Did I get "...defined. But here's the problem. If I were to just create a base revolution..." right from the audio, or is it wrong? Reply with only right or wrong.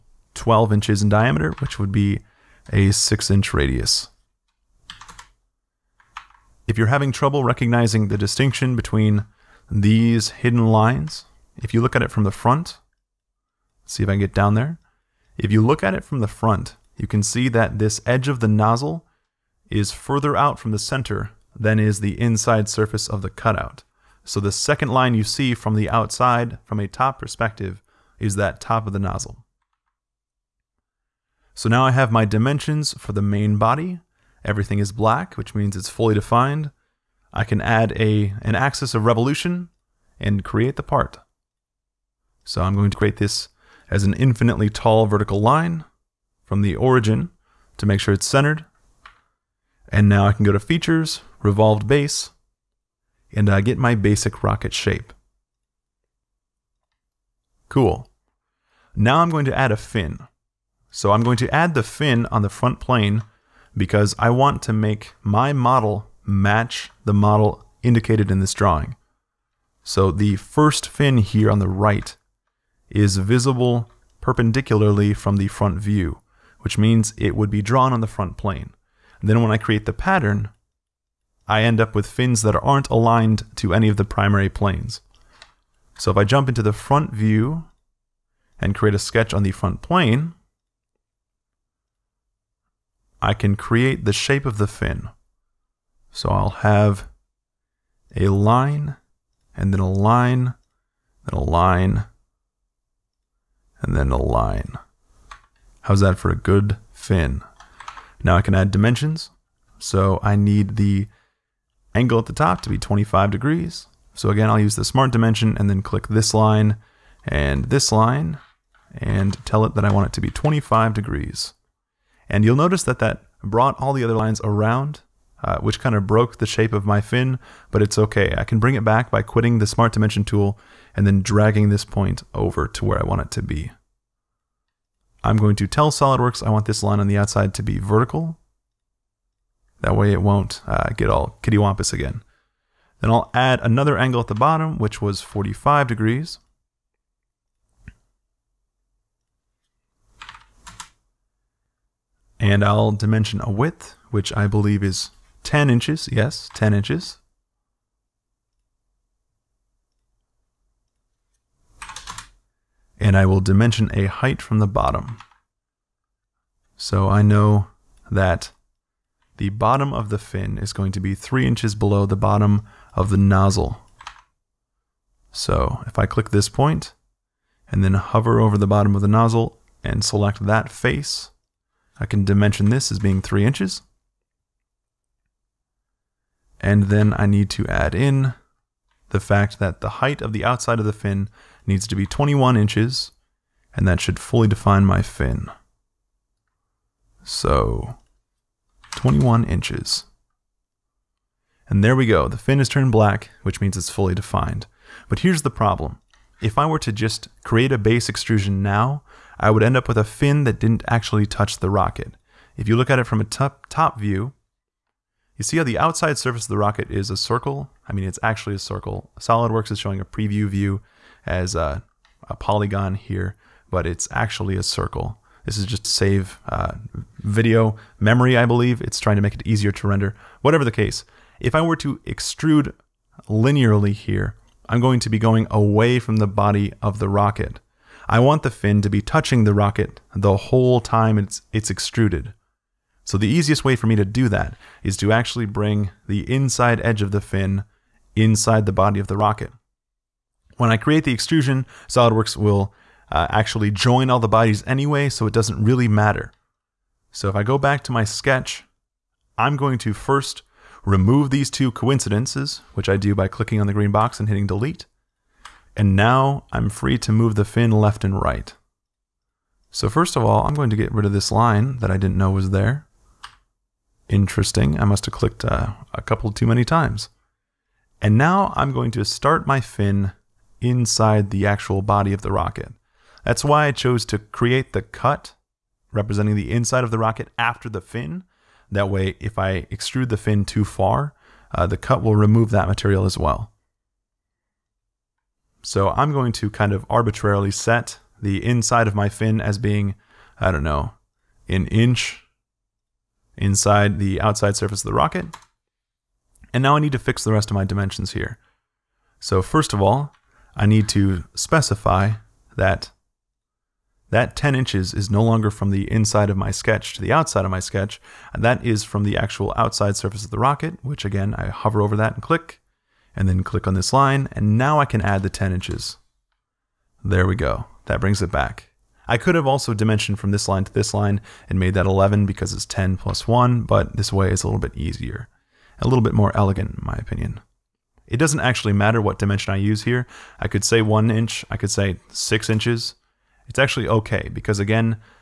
wrong.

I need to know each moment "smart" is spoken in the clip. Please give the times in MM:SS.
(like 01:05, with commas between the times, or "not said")
01:54, 02:09.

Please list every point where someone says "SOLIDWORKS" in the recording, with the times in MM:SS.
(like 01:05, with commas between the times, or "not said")
02:15, 03:39, 04:11.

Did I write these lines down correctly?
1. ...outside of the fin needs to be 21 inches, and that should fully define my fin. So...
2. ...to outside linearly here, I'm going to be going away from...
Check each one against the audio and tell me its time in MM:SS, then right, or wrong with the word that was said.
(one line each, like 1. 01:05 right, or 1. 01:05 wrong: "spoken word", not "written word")
1. 03:10 right
2. 03:51 wrong: "extrude", not "outside".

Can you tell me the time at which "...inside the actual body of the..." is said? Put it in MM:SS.
04:40.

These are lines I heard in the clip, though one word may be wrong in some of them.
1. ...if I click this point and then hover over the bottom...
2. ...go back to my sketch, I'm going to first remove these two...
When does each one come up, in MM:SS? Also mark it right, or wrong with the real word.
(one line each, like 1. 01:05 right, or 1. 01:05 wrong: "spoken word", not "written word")
1. 02:55 right
2. 04:17 right.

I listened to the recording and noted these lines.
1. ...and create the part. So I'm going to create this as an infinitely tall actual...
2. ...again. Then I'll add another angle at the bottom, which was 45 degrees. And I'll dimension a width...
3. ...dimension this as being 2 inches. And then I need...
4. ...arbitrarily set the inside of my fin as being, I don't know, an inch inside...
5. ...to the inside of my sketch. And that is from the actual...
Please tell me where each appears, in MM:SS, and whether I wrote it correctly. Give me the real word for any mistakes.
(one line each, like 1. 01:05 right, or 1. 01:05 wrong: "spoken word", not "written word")
1. 00:40 wrong: "vertical", not "actual"
2. 02:21 right
3. 03:02 wrong: "3", not "2"
4. 04:56 right
5. 05:16 wrong: "outside", not "inside".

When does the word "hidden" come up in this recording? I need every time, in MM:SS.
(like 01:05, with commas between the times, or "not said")
00:10.